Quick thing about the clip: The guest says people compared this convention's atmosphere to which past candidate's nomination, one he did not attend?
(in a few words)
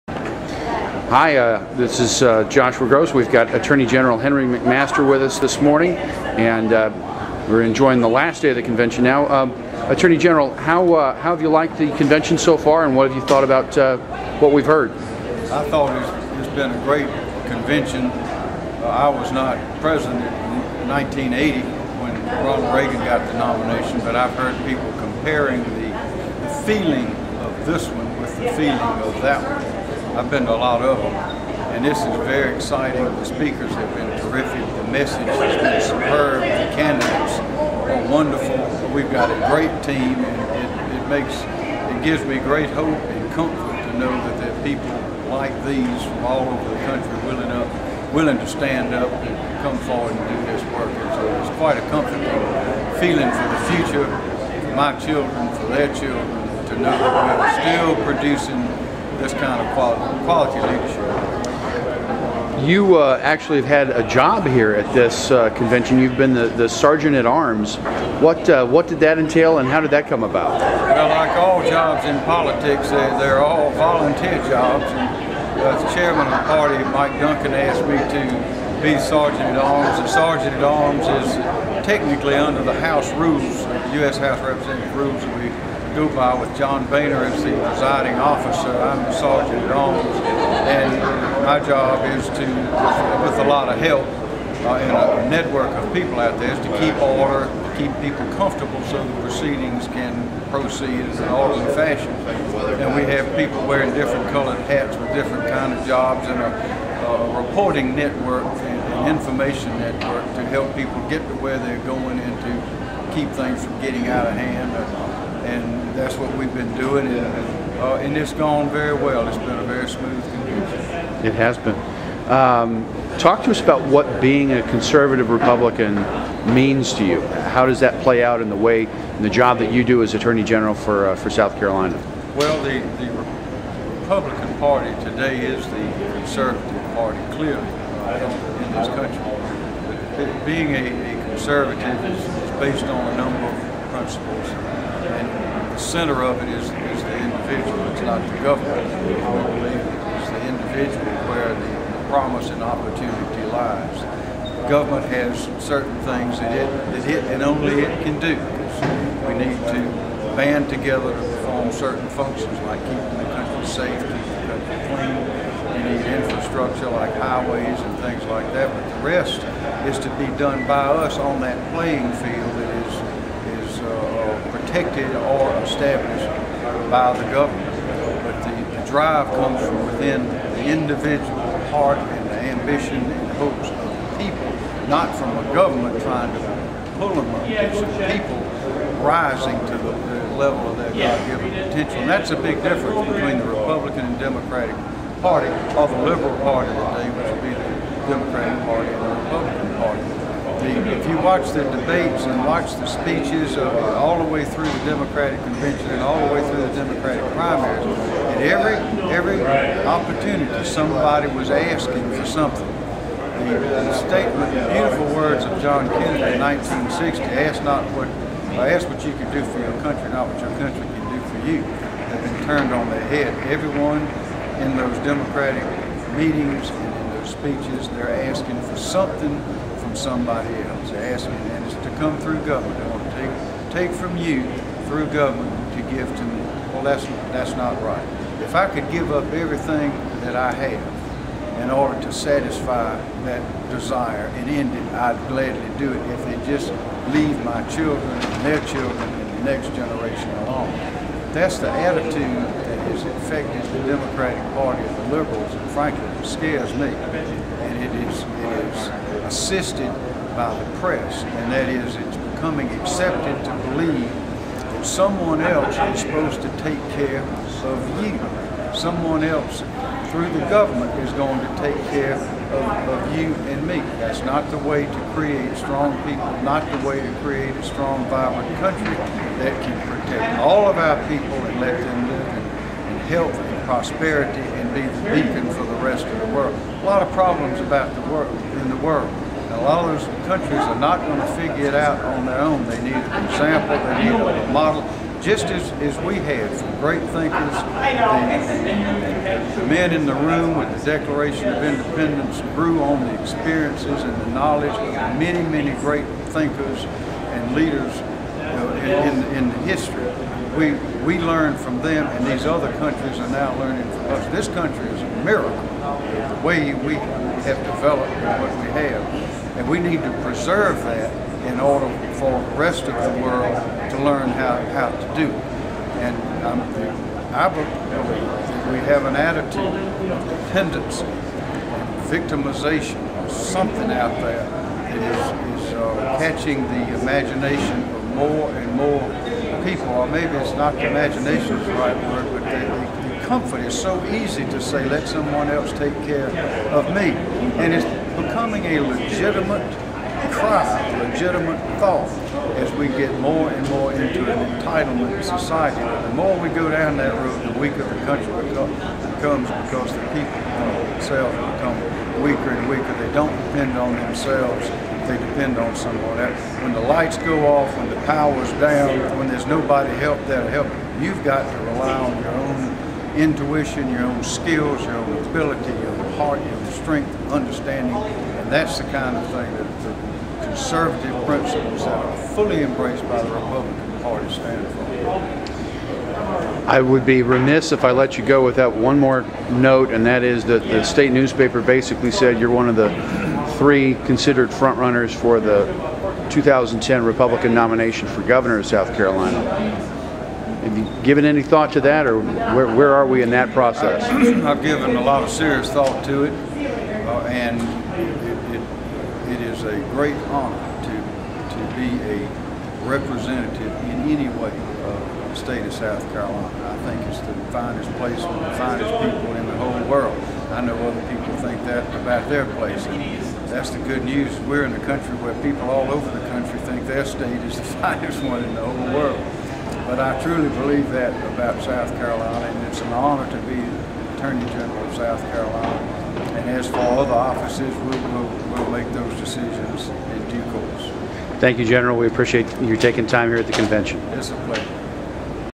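Ronald Reagan.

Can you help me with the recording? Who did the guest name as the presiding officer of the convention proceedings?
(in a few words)
John Boehner.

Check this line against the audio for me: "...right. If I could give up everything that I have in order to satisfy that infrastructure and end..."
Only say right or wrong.
wrong.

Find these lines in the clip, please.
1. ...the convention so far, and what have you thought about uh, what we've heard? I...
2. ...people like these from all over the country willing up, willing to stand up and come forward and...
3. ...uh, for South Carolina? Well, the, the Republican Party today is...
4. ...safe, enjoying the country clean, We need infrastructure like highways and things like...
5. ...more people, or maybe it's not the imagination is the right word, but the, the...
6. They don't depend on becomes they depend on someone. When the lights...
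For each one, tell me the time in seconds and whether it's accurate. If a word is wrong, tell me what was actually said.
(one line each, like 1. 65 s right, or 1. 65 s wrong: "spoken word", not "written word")
1. 11 s right
2. 44 s right
3. 131 s right
4. 163 s wrong: "keeping", not "enjoying"
5. 338 s right
6. 362 s wrong: "themselves", not "becomes".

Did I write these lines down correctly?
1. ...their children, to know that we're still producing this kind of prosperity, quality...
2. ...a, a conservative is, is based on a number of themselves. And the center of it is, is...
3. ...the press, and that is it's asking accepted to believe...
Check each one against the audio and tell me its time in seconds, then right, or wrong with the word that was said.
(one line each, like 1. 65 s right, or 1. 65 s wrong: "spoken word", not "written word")
1. 55 s wrong: "quality", not "prosperity"
2. 140 s wrong: "principles", not "themselves"
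3. 260 s wrong: "becoming", not "asking".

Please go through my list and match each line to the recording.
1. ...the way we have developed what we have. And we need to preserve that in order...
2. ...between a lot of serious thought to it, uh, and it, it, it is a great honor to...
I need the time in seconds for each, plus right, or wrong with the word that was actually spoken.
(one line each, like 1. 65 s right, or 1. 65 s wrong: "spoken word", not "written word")
1. 315 s right
2. 404 s wrong: "given", not "between".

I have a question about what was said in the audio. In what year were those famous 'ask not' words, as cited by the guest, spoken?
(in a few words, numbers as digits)
1960.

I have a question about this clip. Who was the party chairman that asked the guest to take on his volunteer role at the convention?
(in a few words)
Mike Duncan.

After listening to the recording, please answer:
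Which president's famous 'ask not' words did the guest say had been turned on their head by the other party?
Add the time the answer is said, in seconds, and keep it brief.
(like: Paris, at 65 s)
John Kennedy, at 215 s.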